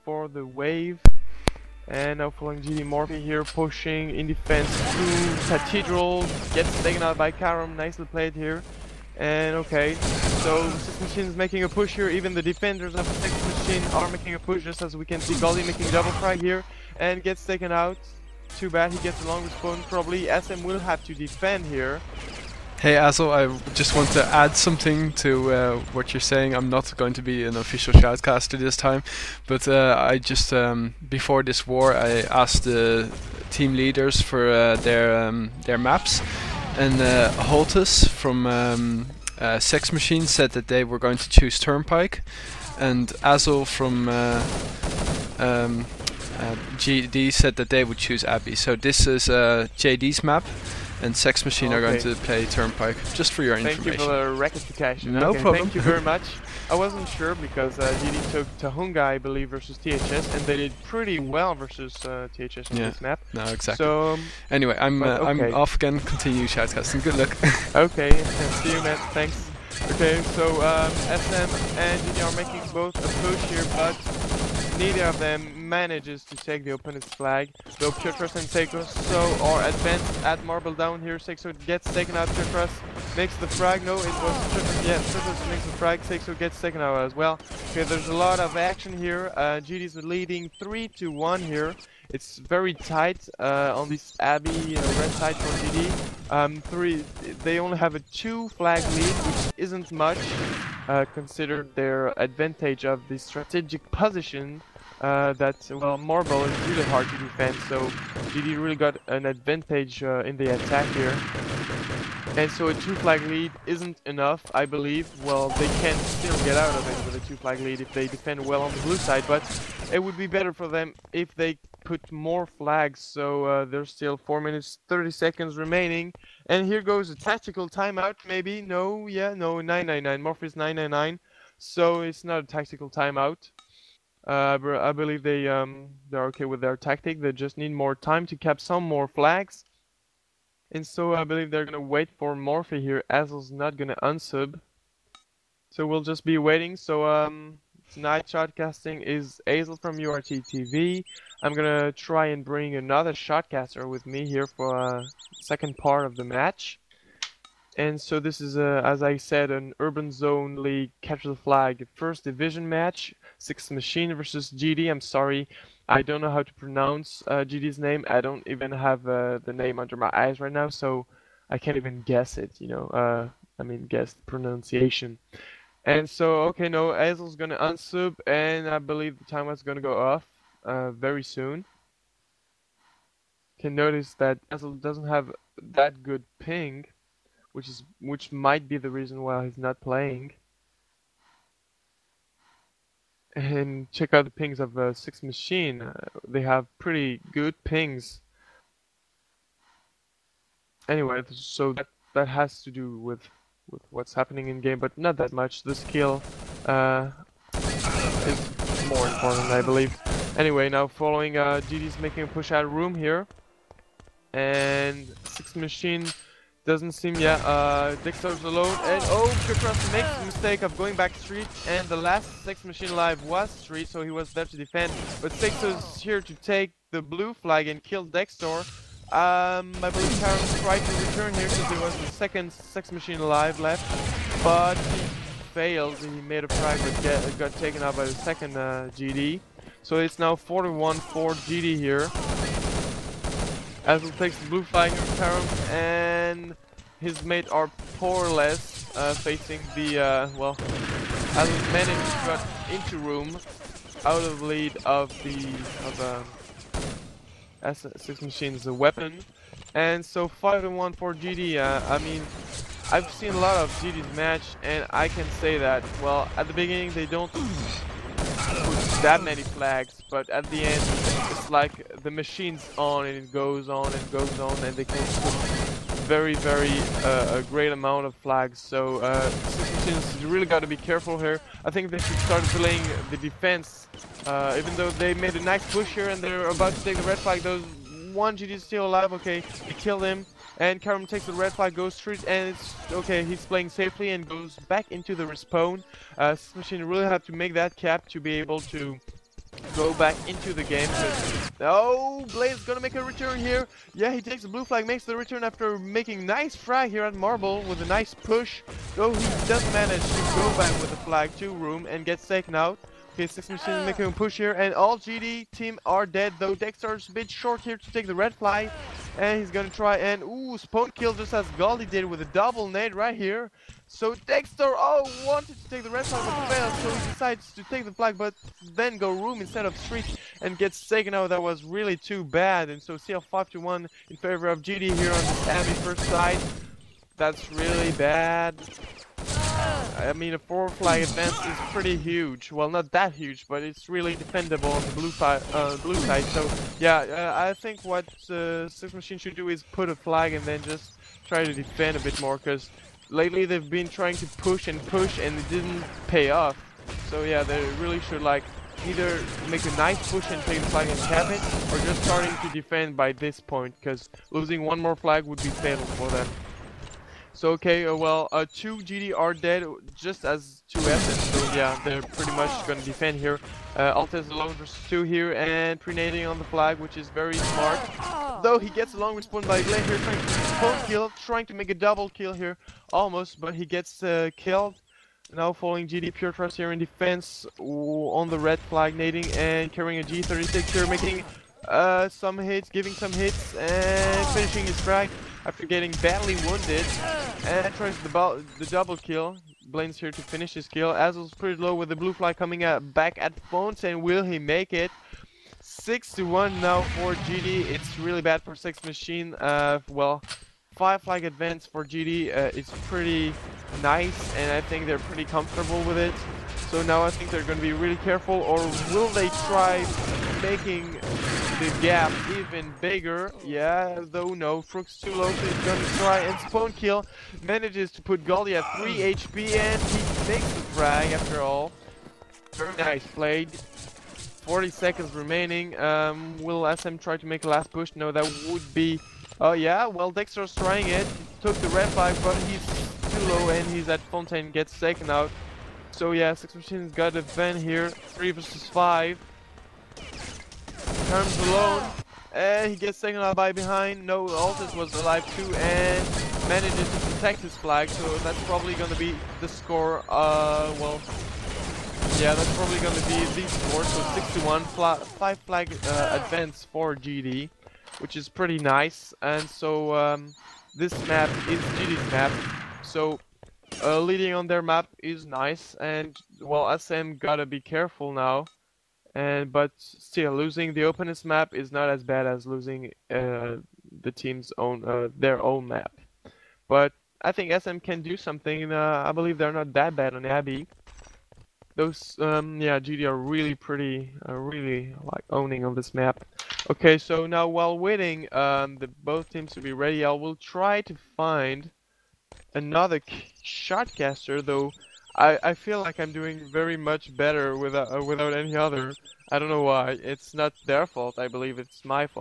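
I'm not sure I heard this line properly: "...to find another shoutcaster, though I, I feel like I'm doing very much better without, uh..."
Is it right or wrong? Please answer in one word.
right.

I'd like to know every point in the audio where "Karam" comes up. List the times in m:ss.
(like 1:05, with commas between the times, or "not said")
0:07, 4:50.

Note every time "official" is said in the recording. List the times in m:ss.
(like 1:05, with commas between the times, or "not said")
0:27.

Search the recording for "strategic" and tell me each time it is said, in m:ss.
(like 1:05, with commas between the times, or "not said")
1:43.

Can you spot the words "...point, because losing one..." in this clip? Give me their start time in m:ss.
6:03.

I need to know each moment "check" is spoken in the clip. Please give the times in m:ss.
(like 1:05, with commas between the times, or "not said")
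3:13.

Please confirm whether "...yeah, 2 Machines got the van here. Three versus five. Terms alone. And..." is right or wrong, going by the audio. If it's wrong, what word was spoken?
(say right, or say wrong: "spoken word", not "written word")
wrong: "6", not "2".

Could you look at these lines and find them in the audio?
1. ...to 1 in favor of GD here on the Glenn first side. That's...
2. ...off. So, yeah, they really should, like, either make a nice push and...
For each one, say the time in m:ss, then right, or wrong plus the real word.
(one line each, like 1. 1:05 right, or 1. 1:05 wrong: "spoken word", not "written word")
1. 5:33 wrong: "Abbey", not "Glenn"
2. 5:56 right.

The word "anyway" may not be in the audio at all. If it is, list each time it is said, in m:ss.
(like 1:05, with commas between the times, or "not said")
1:04, 3:20, 3:30.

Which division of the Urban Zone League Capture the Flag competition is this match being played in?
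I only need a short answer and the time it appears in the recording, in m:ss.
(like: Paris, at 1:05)
First Division, at 2:41.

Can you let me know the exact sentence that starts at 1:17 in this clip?
Though Piotrus and Seiko so are advanced at Marble down here.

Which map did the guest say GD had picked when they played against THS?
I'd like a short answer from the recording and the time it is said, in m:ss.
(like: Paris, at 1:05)
Tohunga, at 0:58.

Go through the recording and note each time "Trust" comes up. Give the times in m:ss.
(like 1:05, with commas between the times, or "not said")
6:26.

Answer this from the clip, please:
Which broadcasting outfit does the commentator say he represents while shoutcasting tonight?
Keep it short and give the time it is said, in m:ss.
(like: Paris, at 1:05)
URT TV, at 2:29.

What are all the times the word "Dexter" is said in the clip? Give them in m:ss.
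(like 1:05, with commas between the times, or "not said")
3:48, 5:16, 5:24, 7:20.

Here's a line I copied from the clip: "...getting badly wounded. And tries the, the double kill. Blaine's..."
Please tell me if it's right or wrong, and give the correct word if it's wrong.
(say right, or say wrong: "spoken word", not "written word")
right.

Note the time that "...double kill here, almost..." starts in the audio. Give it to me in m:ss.
6:21.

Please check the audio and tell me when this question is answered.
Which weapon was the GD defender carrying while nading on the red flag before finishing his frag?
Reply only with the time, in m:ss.
6:30.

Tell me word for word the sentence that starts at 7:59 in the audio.
And but still, losing the openness map is not as bad as losing uh, the team's own uh, their own map.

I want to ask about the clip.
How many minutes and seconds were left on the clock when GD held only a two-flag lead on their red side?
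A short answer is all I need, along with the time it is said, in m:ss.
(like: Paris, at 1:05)
4 minutes 30 seconds, at 2:04.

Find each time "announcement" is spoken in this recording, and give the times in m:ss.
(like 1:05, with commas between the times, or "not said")
not said.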